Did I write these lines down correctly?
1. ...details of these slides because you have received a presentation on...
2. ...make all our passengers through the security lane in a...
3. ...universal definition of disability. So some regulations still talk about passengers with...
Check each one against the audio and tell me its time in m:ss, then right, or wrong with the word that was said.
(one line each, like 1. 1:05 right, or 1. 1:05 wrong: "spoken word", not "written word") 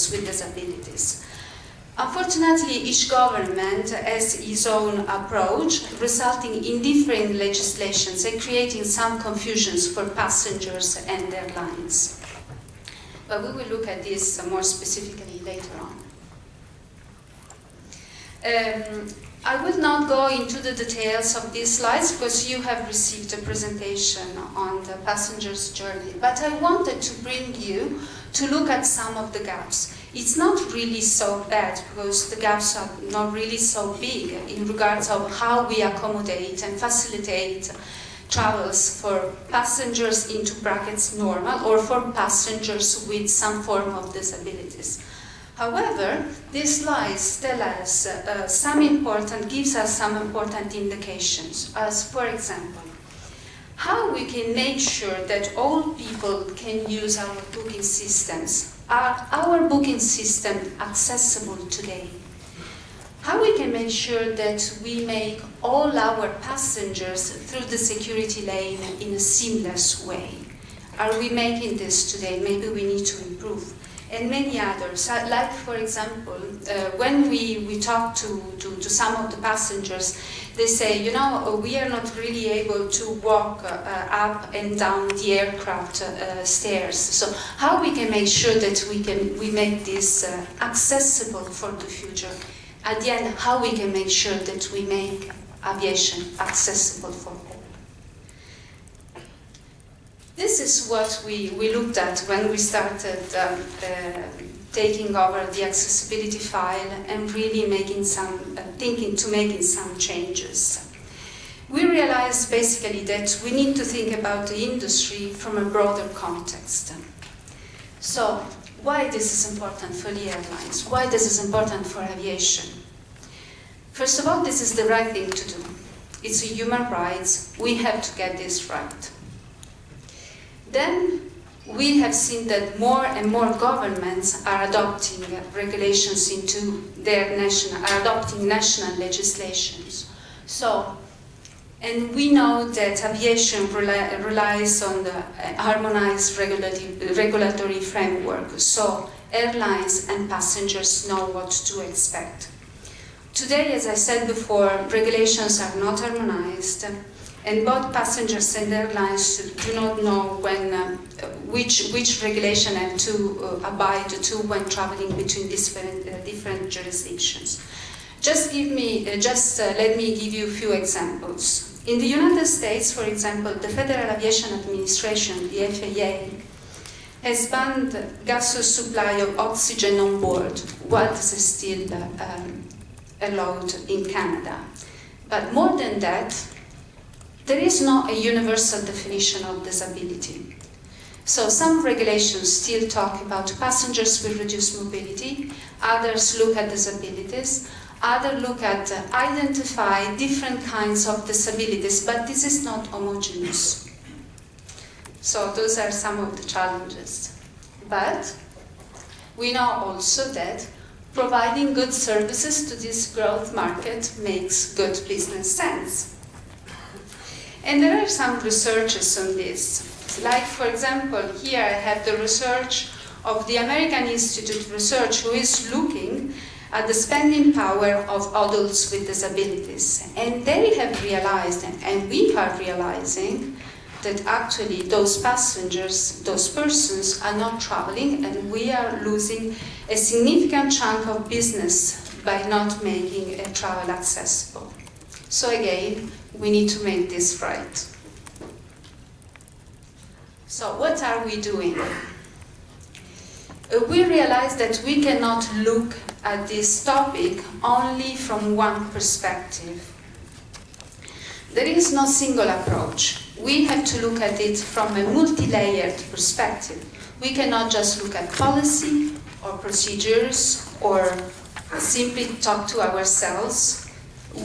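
1. 0:20 right
2. 1:05 right
3. 3:08 right.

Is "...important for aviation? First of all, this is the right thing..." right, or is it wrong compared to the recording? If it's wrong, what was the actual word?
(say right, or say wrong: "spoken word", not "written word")
right.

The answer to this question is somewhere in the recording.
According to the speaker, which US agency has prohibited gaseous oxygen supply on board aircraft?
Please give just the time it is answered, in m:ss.
2:53.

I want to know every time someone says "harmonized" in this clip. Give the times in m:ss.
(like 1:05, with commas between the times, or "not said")
2:25, 2:35.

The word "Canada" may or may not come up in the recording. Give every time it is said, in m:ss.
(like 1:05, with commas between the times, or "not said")
3:04.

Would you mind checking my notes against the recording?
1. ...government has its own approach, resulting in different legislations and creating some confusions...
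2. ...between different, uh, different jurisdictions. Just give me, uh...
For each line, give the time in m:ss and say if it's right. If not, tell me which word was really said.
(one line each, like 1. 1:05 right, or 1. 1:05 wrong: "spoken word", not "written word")
1. 0:03 right
2. 2:45 right.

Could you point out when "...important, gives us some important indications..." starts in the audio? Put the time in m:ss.
0:48.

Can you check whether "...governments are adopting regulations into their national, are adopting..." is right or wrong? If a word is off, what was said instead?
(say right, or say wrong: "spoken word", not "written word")
right.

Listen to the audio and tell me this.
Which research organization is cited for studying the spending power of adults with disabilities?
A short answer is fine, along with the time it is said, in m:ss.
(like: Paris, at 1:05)
American Institute of Research, at 3:43.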